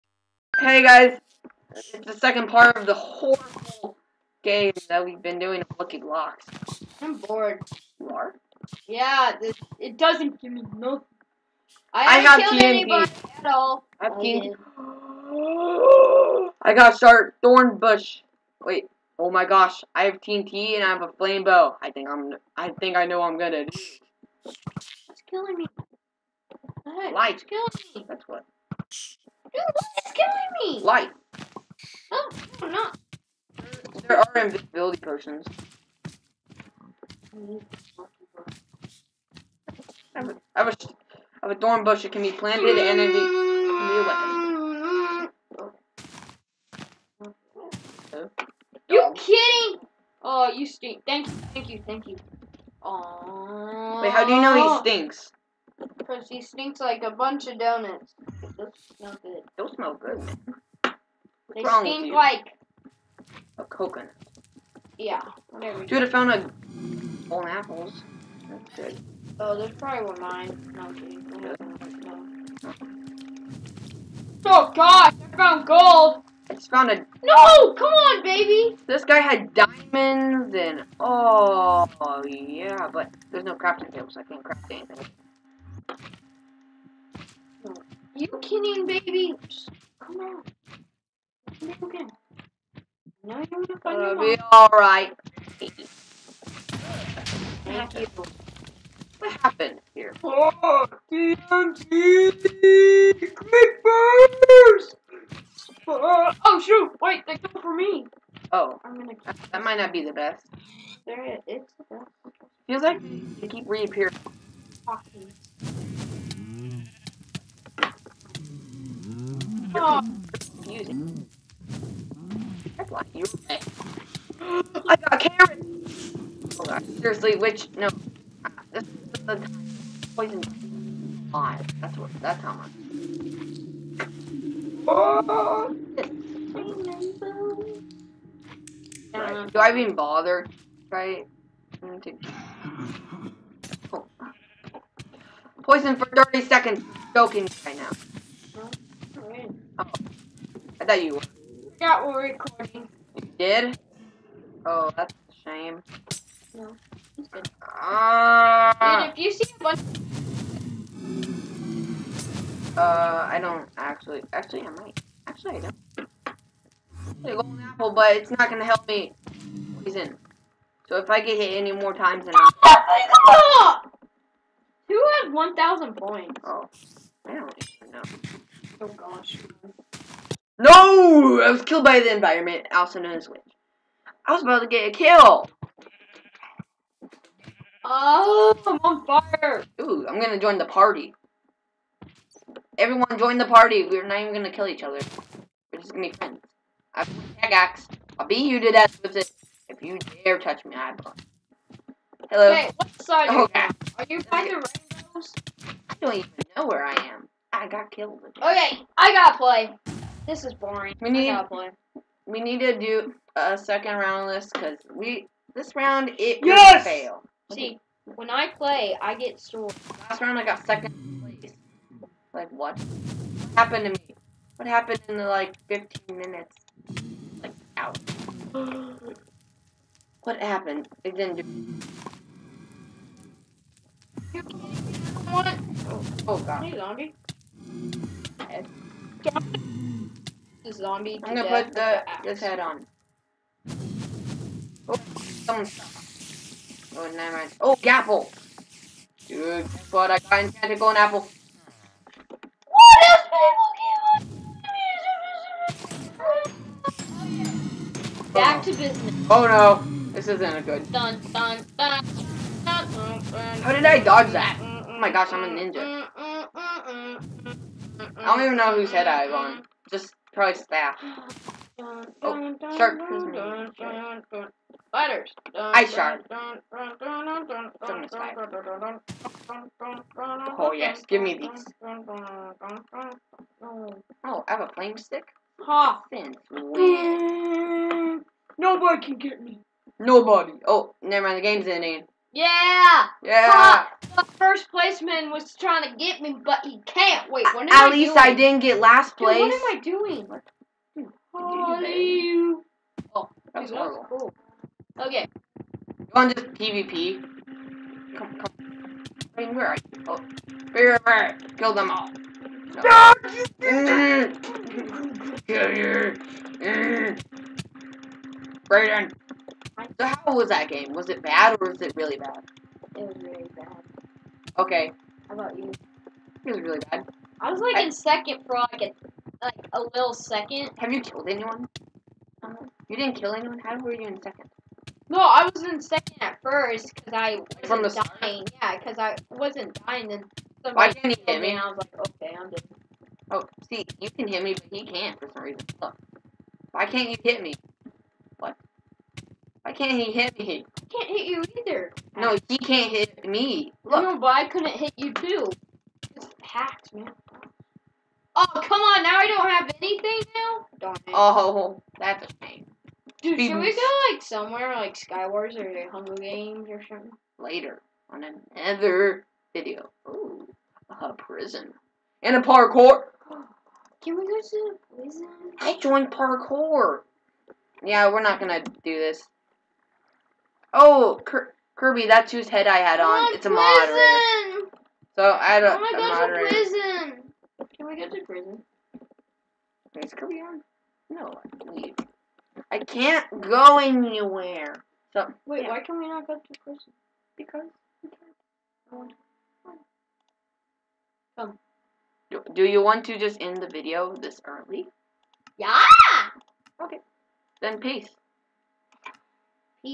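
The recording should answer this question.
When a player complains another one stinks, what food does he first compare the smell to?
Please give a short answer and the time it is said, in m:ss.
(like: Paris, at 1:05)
Donuts, at 0:57.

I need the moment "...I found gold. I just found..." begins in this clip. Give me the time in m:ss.
1:15.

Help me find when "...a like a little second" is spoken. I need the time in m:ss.
5:28.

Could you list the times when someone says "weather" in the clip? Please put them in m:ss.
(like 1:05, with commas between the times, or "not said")
not said.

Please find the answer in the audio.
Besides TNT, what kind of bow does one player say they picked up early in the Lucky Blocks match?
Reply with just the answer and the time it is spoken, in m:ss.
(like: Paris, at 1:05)
Flame bow, at 0:21.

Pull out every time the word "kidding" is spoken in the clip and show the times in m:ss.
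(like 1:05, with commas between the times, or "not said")
0:49, 1:28.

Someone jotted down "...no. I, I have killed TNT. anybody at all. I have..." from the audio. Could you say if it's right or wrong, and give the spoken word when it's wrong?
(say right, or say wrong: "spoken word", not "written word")
right.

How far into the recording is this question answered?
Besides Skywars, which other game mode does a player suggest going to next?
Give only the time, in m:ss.
6:05.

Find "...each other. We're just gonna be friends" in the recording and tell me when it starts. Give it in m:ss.
3:14.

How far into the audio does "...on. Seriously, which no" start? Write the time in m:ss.
2:06.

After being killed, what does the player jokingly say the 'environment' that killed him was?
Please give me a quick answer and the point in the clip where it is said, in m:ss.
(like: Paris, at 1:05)
Wind, at 3:03.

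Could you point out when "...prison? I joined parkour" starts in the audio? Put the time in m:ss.
6:14.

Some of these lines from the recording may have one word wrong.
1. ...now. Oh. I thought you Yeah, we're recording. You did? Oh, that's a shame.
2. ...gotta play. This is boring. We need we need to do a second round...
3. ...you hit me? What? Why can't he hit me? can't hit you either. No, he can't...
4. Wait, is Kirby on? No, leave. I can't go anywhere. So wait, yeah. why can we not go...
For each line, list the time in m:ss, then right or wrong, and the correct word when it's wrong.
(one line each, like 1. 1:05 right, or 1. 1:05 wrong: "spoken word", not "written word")
1. 2:27 right
2. 3:29 right
3. 5:47 right
4. 6:29 right.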